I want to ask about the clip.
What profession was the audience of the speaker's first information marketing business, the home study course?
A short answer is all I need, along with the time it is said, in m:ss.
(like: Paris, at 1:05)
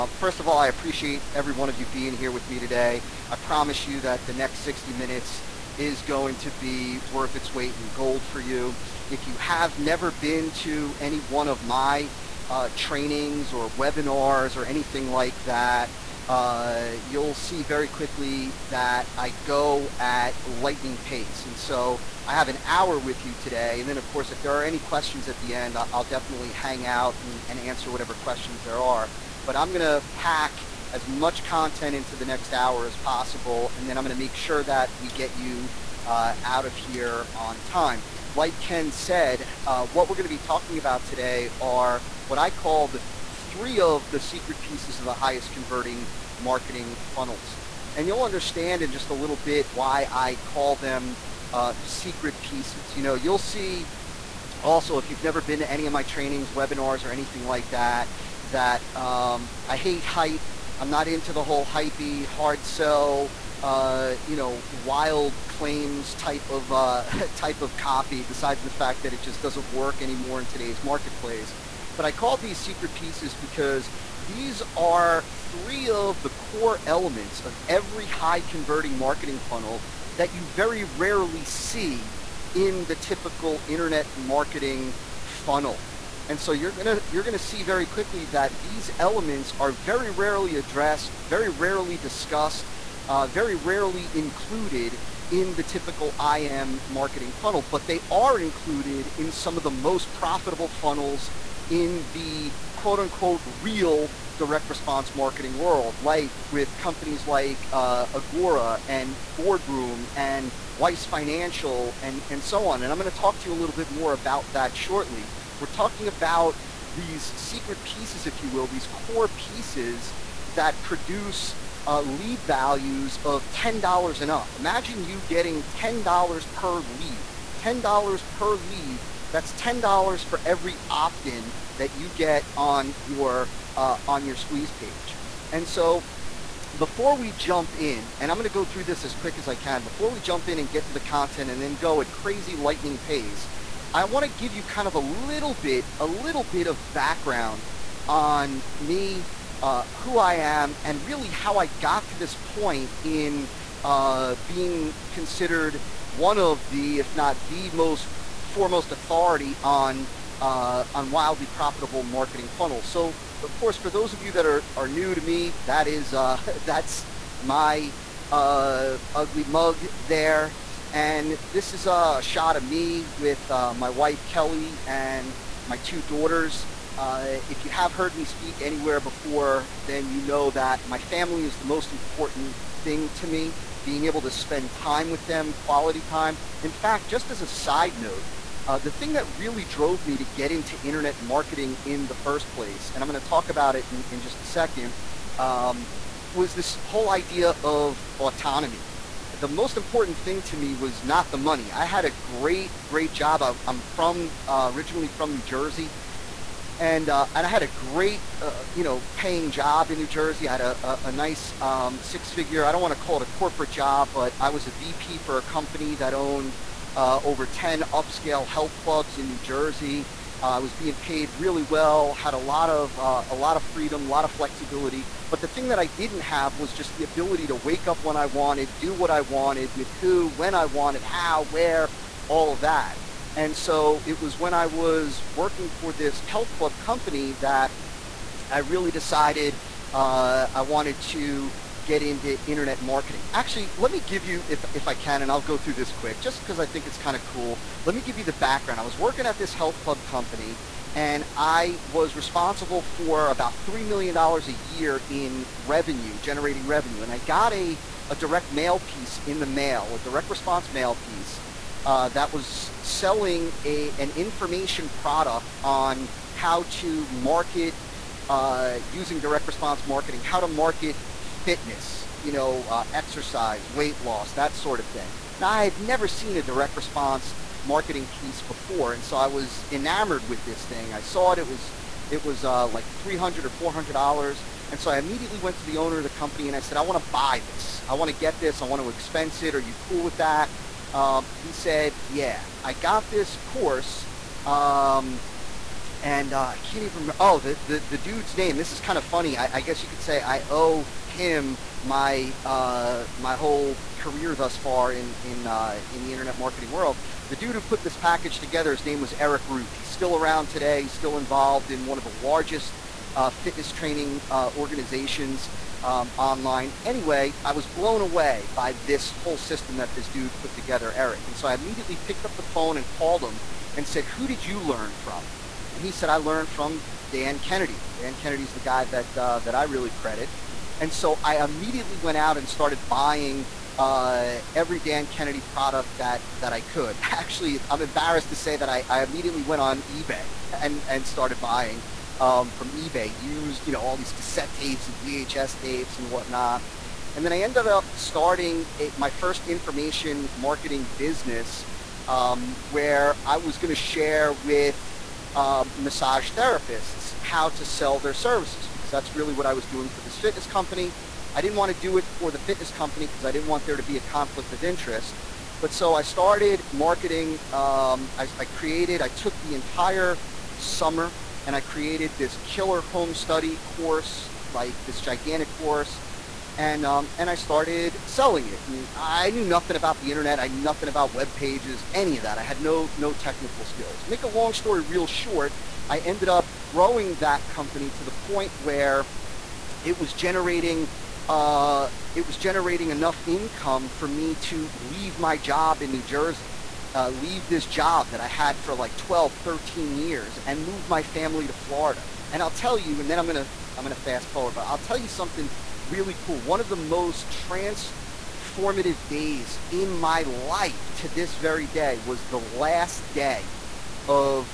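massage therapists, at 5:55.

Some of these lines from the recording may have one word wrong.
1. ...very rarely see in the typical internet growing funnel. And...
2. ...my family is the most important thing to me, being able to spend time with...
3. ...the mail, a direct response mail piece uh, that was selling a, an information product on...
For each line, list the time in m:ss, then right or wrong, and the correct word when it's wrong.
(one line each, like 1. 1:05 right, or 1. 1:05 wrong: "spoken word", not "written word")
1. 1:20 wrong: "marketing", not "growing"
2. 3:00 right
3. 4:19 right.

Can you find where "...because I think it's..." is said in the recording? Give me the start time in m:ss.
4:06.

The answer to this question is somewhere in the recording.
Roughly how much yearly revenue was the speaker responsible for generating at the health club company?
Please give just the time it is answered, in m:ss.
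4:13.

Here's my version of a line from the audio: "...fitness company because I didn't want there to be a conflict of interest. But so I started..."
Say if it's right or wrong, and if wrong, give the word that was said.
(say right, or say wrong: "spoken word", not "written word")
right.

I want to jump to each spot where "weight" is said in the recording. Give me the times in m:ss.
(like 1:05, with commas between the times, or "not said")
0:07, 4:33.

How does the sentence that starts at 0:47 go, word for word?
And you'll understand in just a little bit why I call them uh, secret pieces.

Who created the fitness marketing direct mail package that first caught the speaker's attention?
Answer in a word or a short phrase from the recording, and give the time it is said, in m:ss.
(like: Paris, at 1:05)
Eric Ruth, at 5:09.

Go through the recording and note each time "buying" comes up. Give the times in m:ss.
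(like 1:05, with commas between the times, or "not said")
5:32, 5:41.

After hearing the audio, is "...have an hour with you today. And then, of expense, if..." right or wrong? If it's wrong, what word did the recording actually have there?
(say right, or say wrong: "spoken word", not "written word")
wrong: "course", not "expense".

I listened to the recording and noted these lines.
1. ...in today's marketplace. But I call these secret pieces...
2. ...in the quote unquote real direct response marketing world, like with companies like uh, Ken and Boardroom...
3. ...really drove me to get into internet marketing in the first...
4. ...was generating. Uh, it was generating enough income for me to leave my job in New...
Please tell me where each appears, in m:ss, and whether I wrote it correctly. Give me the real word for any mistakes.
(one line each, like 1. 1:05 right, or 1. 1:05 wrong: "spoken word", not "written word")
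1. 1:10 right
2. 1:41 wrong: "Agora", not "Ken"
3. 3:09 right
4. 6:29 right.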